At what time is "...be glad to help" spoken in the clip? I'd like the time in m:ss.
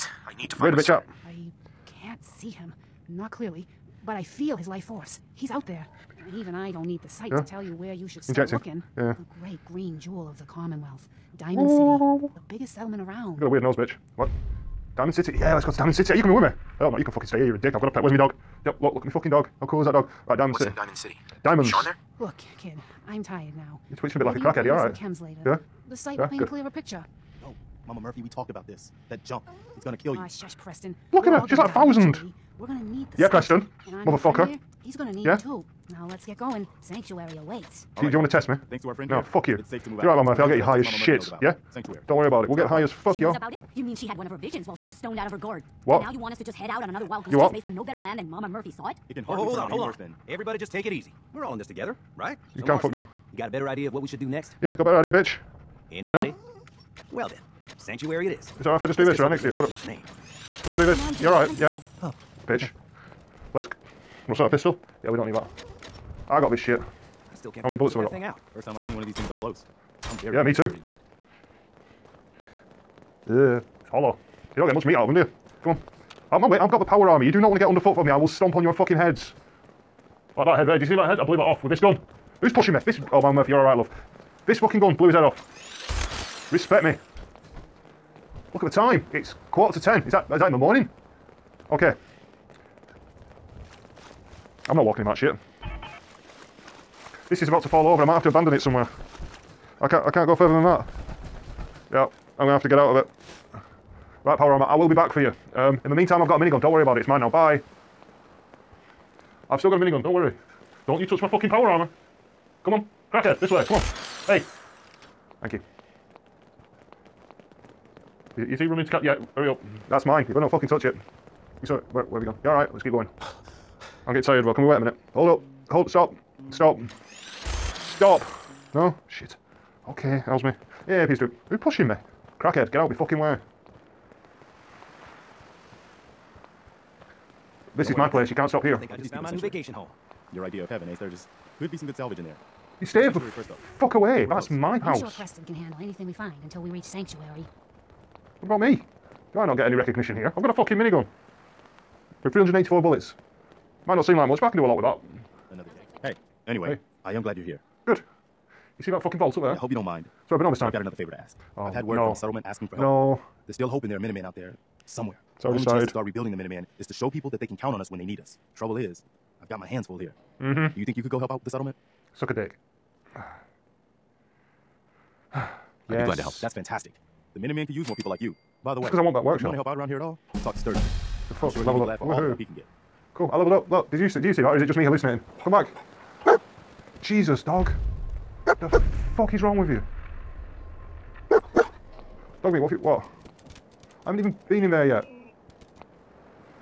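2:56.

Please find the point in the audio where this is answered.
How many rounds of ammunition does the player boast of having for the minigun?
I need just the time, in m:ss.
2:32.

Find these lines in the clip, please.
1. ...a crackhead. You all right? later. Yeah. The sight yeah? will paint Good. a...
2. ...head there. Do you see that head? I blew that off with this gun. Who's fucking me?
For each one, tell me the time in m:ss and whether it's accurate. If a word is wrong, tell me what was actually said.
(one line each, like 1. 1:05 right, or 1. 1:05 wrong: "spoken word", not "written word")
1. 0:24 right
2. 1:20 wrong: "pushing", not "fucking".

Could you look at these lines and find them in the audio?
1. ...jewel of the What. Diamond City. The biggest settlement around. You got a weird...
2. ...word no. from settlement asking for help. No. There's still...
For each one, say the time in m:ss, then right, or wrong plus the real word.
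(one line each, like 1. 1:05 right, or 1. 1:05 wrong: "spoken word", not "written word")
1. 0:09 wrong: "Commonwealth", not "What"
2. 2:41 right.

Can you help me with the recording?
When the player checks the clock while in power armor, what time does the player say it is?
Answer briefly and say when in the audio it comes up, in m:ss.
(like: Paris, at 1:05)
quarter to ten, at 1:29.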